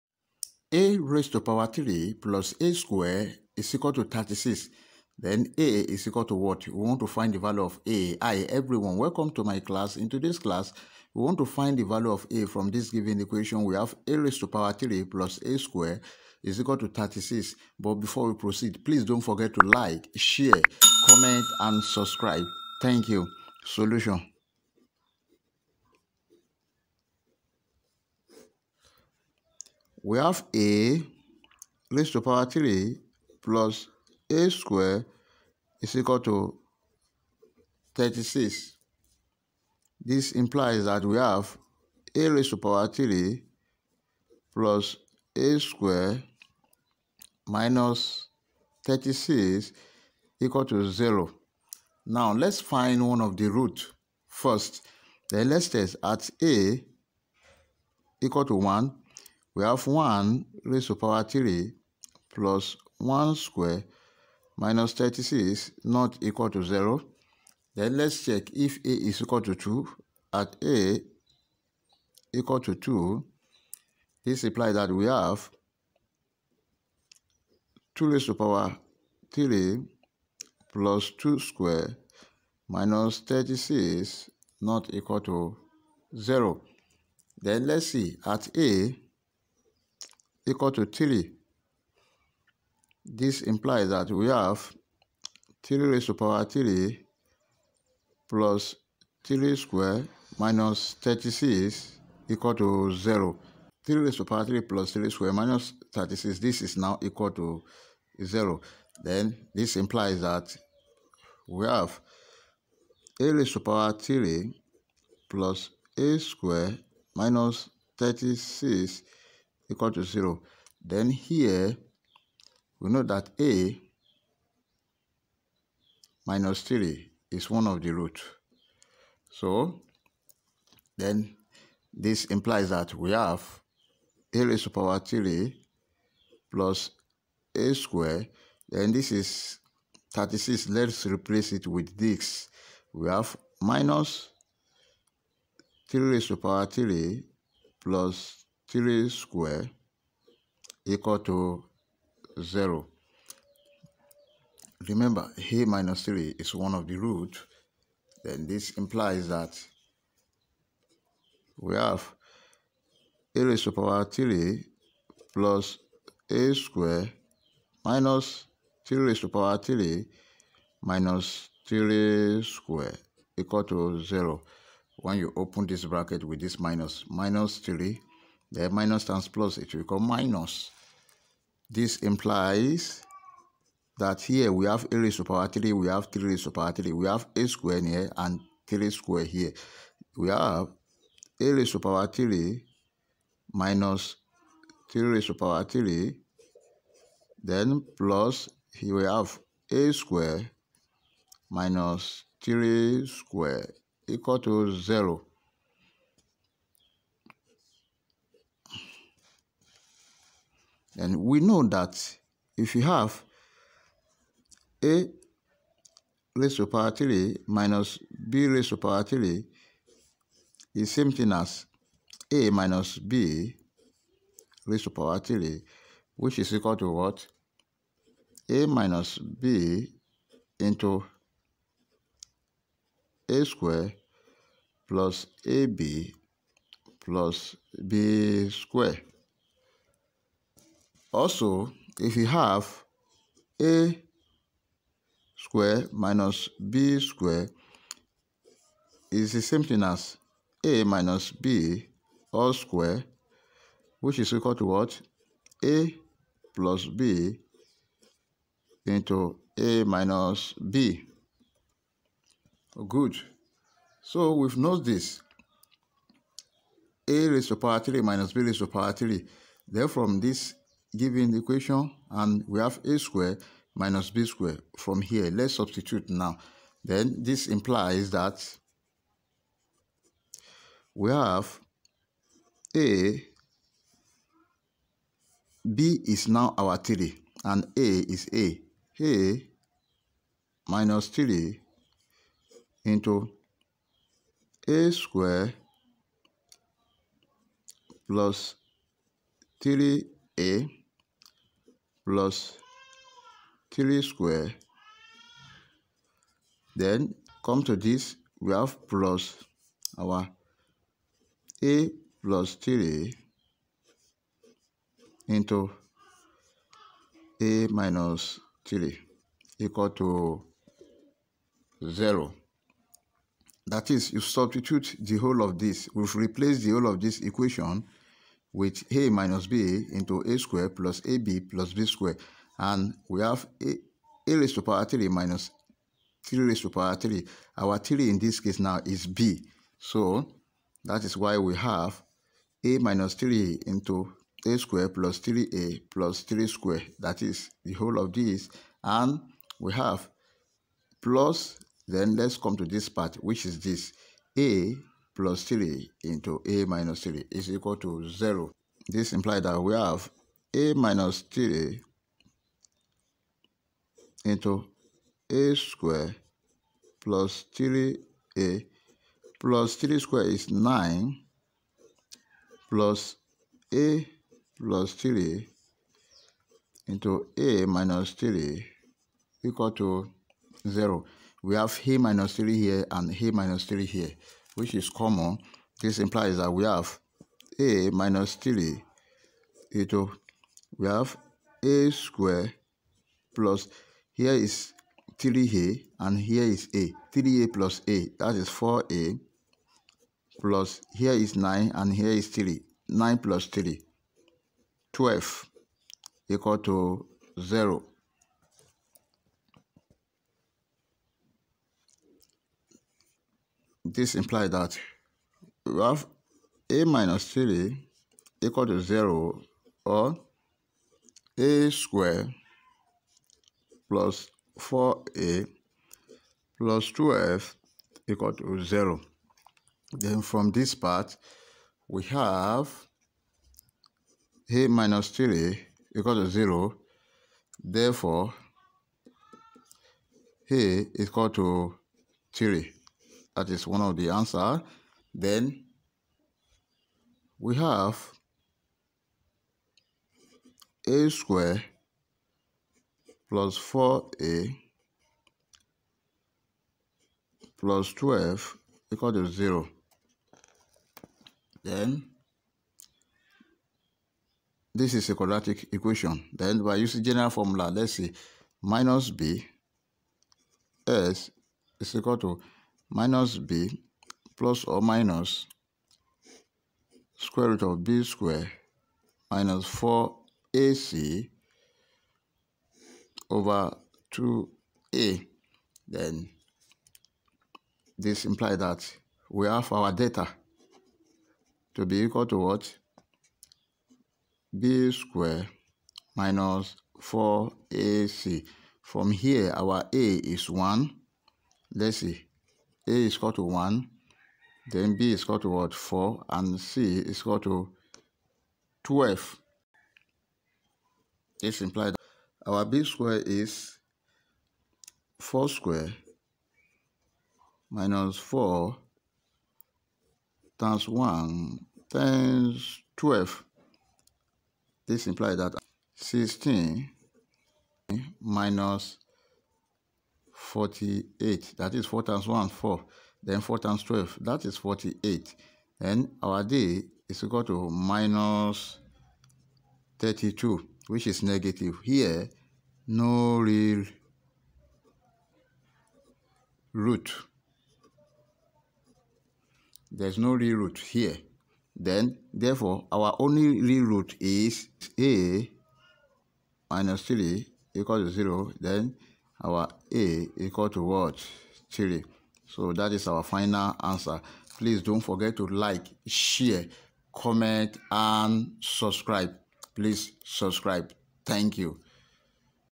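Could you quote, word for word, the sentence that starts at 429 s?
Then from this part, we have a minus 3 equal to 0.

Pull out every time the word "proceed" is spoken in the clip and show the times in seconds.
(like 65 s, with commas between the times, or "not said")
18 s.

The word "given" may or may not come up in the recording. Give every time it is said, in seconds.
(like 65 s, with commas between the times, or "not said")
12 s, 270 s.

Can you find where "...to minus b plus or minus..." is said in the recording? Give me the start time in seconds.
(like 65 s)
472 s.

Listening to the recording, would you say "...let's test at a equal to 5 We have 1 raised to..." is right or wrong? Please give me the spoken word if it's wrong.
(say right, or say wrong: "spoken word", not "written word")
wrong: "1", not "5".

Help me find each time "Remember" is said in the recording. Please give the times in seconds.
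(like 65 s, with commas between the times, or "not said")
154 s.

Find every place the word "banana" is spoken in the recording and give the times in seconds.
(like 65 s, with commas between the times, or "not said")
not said.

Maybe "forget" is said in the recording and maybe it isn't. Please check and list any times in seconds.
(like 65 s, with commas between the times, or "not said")
19 s, 565 s.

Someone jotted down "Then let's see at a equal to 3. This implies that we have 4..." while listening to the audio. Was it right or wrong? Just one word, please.
wrong.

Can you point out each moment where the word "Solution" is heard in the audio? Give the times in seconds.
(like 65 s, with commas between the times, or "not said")
23 s.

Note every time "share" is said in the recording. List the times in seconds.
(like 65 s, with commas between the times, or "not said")
20 s, 566 s.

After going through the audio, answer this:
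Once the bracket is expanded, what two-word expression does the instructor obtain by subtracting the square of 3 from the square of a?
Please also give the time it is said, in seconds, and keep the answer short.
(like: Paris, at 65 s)
a square minus 3 square, at 199 s.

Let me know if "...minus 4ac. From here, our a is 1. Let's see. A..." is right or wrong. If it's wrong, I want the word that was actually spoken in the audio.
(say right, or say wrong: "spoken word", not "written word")
right.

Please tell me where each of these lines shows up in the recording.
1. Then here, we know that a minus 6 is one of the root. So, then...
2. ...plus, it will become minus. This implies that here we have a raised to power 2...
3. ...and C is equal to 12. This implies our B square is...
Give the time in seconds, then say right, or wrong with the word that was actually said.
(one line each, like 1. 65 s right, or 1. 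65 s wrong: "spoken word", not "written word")
1. 120 s wrong: "3", not "6"
2. 179 s wrong: "3", not "2"
3. 506 s right.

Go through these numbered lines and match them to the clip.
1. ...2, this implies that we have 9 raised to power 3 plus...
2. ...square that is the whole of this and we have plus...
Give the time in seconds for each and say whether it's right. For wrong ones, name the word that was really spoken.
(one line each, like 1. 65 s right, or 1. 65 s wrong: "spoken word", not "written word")
1. 72 s wrong: "2", not "9"
2. 346 s right.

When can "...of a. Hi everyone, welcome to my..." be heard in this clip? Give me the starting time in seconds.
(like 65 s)
7 s.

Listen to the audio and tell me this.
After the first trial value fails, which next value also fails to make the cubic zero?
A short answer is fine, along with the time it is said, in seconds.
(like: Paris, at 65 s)
2, at 68 s.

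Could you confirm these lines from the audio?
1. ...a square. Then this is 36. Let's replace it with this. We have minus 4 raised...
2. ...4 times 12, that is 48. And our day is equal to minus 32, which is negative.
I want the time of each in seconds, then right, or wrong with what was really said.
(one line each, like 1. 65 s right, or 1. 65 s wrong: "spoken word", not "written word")
1. 137 s wrong: "3", not "4"
2. 533 s right.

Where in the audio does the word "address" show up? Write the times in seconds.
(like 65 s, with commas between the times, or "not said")
not said.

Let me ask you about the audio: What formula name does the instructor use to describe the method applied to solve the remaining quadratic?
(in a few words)
general formula.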